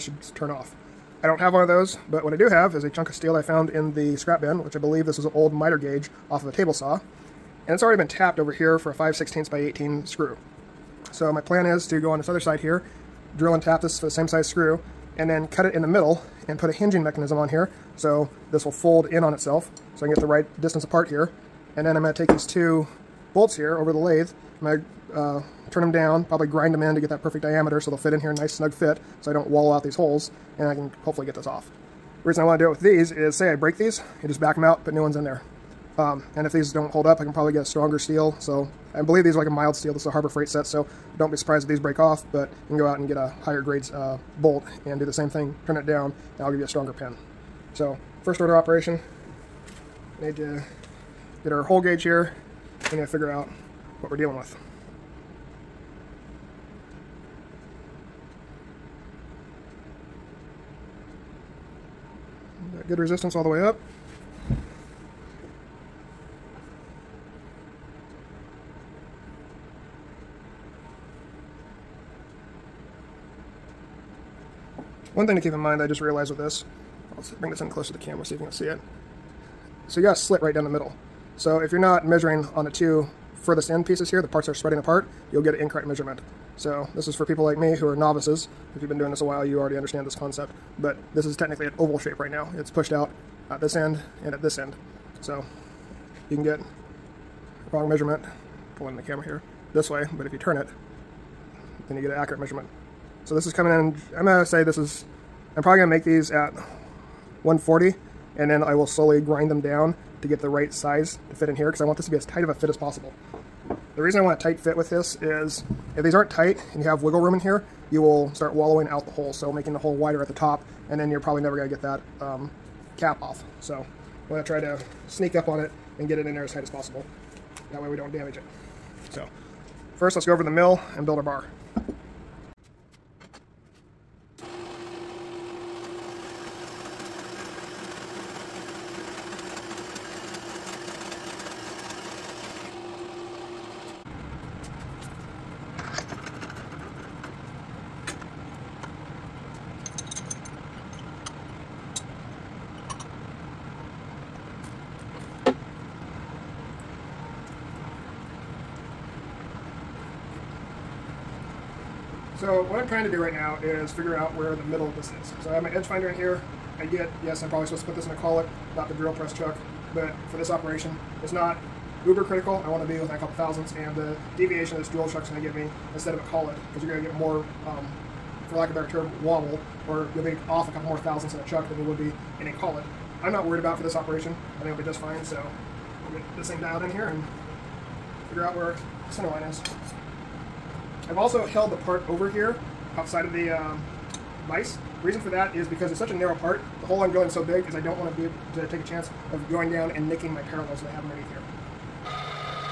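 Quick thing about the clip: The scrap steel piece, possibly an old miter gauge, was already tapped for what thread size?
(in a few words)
5/16 by 18.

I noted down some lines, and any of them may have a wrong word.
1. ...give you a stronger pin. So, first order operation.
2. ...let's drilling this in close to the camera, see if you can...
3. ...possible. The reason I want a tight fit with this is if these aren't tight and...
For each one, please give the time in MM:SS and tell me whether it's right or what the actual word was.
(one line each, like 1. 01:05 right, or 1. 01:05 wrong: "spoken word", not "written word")
1. 00:46 right
2. 01:17 wrong: "bring", not "drilling"
3. 01:52 right.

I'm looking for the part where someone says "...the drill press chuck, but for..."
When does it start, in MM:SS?
02:48.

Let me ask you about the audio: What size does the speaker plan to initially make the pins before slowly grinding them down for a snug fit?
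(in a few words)
140.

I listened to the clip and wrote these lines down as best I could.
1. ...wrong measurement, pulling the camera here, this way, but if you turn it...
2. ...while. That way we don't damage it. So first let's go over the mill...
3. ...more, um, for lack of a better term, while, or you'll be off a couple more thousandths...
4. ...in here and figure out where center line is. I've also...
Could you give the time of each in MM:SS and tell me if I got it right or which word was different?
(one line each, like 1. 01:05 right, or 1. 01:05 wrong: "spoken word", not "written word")
1. 01:37 right
2. 02:06 wrong: "possible", not "while"
3. 02:57 wrong: "wobble", not "while"
4. 03:06 right.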